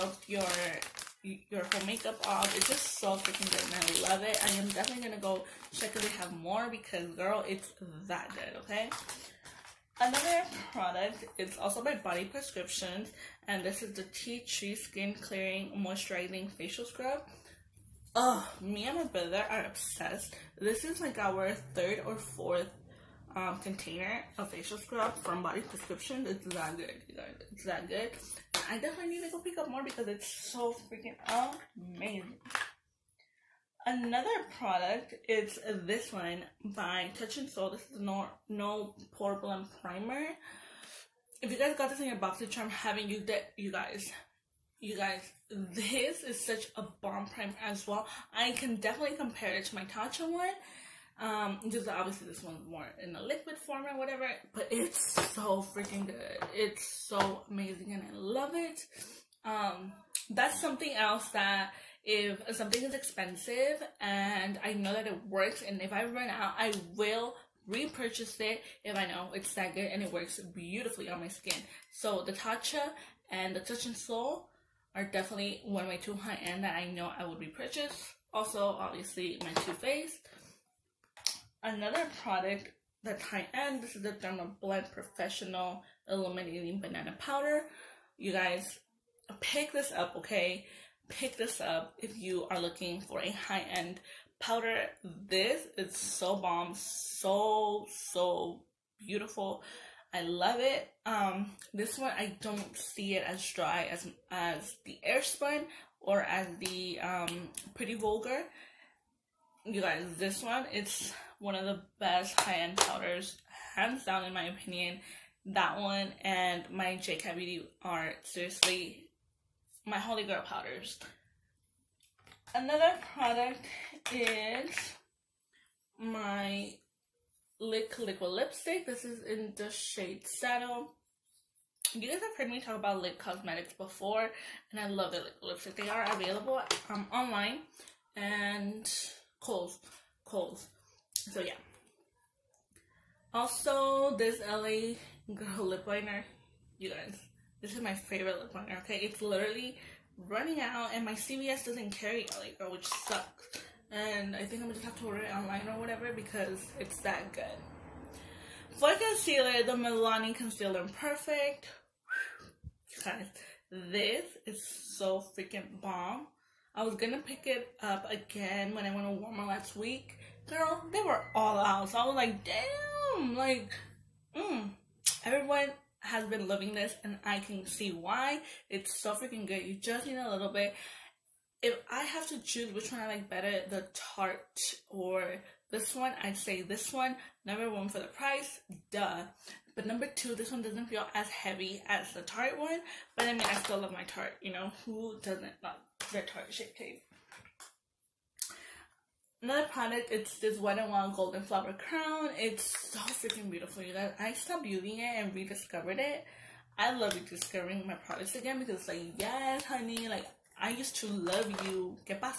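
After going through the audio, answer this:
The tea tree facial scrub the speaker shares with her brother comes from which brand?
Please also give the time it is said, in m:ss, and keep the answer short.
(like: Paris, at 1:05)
Body Prescriptions, at 0:11.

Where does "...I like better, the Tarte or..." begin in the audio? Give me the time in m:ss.
3:03.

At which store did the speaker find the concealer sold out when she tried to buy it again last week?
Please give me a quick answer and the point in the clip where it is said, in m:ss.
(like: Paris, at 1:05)
Walmart, at 2:49.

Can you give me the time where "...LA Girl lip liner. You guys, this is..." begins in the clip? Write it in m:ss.
2:24.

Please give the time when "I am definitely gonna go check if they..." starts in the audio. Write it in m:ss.
0:04.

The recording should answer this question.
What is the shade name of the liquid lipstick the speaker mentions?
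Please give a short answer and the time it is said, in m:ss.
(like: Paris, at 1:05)
Saddle, at 2:10.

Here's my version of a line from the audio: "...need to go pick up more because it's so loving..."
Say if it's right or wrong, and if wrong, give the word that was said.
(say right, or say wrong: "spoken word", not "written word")
wrong: "freaking", not "loving".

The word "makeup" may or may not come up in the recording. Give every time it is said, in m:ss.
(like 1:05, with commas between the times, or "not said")
0:01.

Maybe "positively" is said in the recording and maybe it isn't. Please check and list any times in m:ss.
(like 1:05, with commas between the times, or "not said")
not said.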